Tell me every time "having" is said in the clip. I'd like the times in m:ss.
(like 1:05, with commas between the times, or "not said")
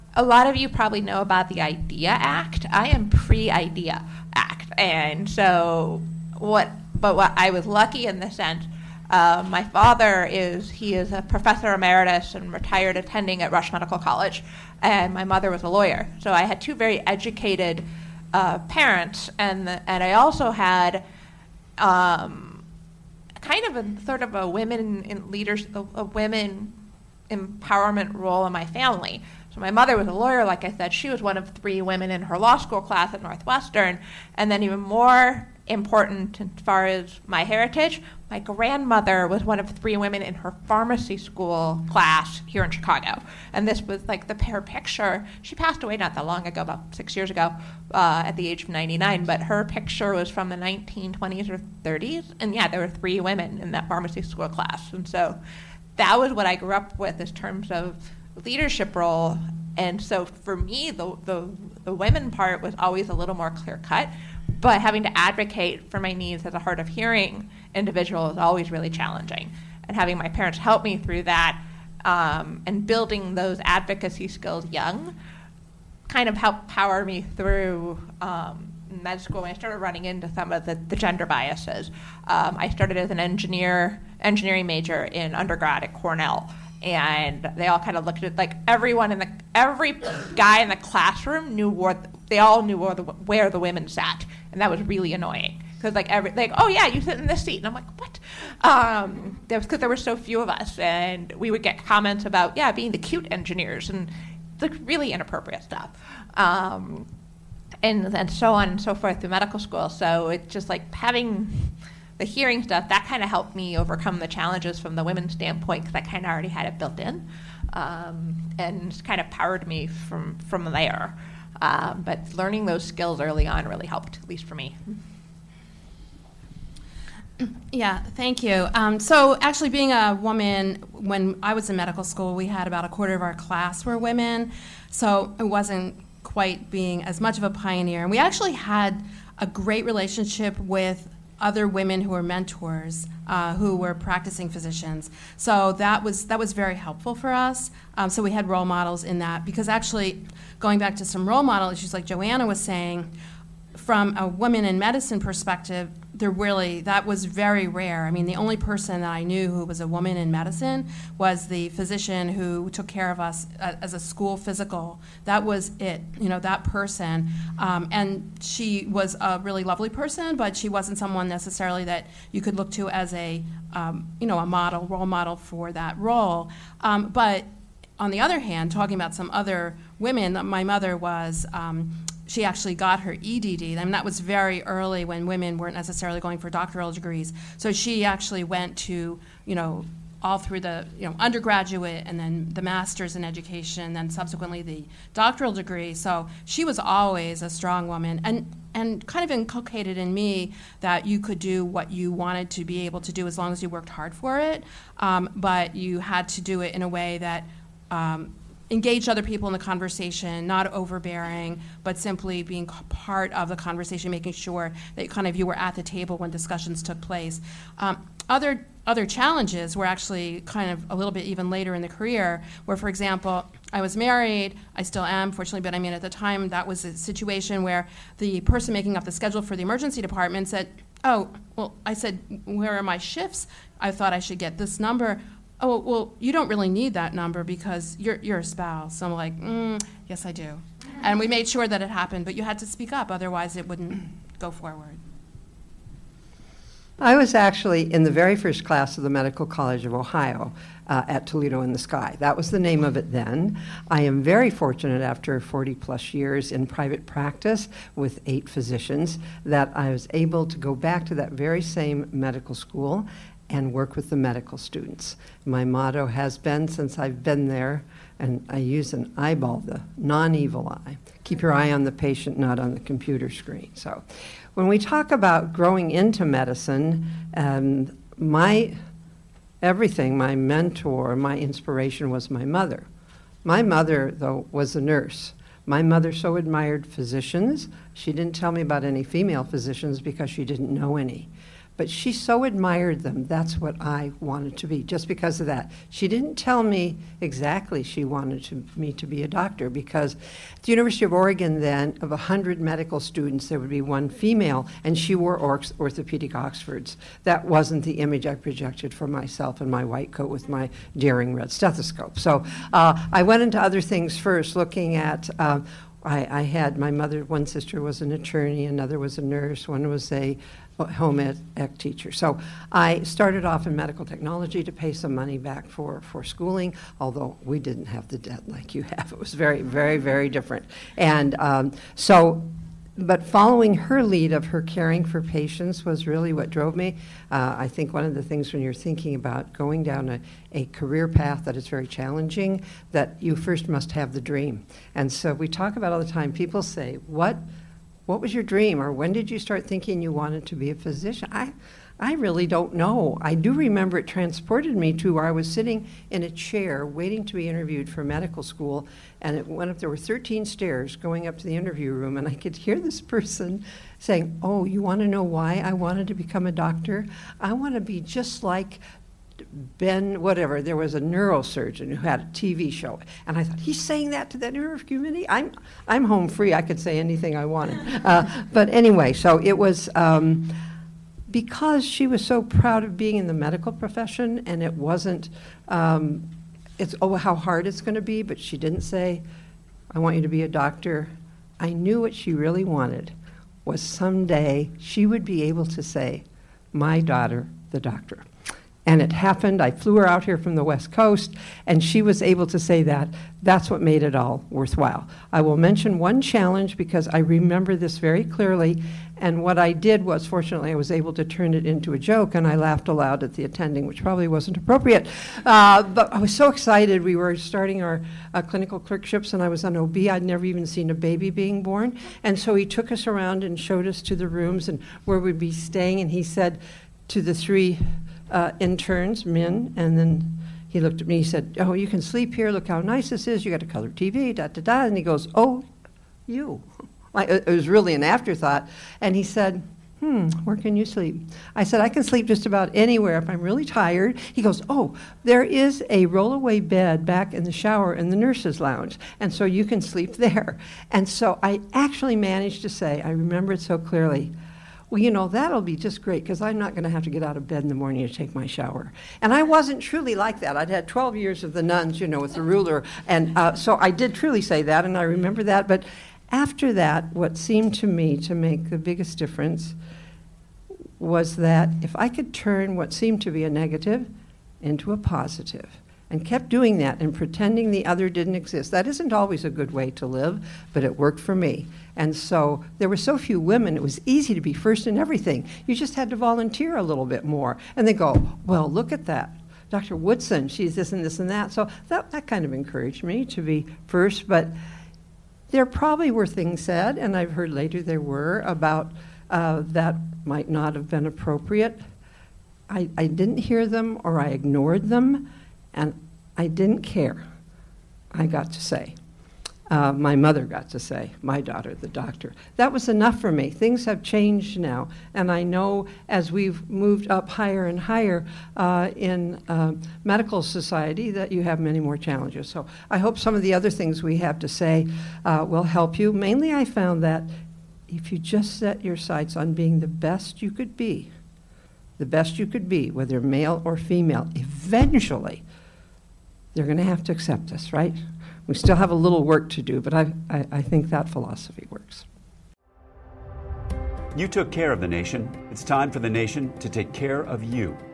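1:04, 1:09, 1:50.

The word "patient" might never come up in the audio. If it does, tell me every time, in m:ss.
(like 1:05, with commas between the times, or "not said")
4:31, 5:35.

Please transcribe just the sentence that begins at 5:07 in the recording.
That wasn't the image I projected for myself in my white coat with my daring red stethoscope.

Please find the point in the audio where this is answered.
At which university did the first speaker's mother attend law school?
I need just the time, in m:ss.
0:33.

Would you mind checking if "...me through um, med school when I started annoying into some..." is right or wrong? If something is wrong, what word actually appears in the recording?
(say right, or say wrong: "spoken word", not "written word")
wrong: "running", not "annoying".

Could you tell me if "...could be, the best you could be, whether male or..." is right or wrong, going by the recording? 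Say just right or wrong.
right.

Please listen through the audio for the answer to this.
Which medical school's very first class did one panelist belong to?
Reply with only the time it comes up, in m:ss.
4:09.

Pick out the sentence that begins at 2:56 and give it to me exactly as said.
Um, but on the other hand, talking about some other women, my mother was um, she actually got her EDD.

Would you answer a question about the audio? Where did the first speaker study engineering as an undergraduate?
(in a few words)
Cornell.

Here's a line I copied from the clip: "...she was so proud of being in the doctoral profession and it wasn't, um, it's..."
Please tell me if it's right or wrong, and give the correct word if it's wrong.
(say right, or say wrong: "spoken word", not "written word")
wrong: "medical", not "doctoral".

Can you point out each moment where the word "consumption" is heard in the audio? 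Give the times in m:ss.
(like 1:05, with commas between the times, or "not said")
not said.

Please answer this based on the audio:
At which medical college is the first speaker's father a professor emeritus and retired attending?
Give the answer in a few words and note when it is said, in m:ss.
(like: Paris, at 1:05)
Rush Medical College, at 0:13.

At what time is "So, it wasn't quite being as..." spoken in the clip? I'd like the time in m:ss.
2:14.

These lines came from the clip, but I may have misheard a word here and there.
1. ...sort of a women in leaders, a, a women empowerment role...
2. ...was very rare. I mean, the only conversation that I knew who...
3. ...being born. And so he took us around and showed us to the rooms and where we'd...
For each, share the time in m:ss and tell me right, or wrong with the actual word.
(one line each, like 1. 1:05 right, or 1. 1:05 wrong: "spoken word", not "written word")
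1. 0:24 right
2. 2:37 wrong: "person", not "conversation"
3. 7:01 right.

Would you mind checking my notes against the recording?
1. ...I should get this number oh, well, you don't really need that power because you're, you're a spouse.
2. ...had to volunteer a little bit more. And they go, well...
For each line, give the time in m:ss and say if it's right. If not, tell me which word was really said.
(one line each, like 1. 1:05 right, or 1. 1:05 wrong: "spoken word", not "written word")
1. 3:54 wrong: "number", not "power"
2. 8:05 right.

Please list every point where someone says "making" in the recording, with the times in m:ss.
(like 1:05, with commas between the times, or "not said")
3:34, 3:48.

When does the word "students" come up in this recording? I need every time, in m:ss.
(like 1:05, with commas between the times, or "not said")
4:24, 5:03.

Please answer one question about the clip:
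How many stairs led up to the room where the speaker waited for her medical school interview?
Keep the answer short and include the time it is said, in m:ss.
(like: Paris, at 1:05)
13, at 5:59.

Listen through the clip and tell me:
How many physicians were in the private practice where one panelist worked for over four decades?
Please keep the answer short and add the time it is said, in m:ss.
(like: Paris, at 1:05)
8, at 4:18.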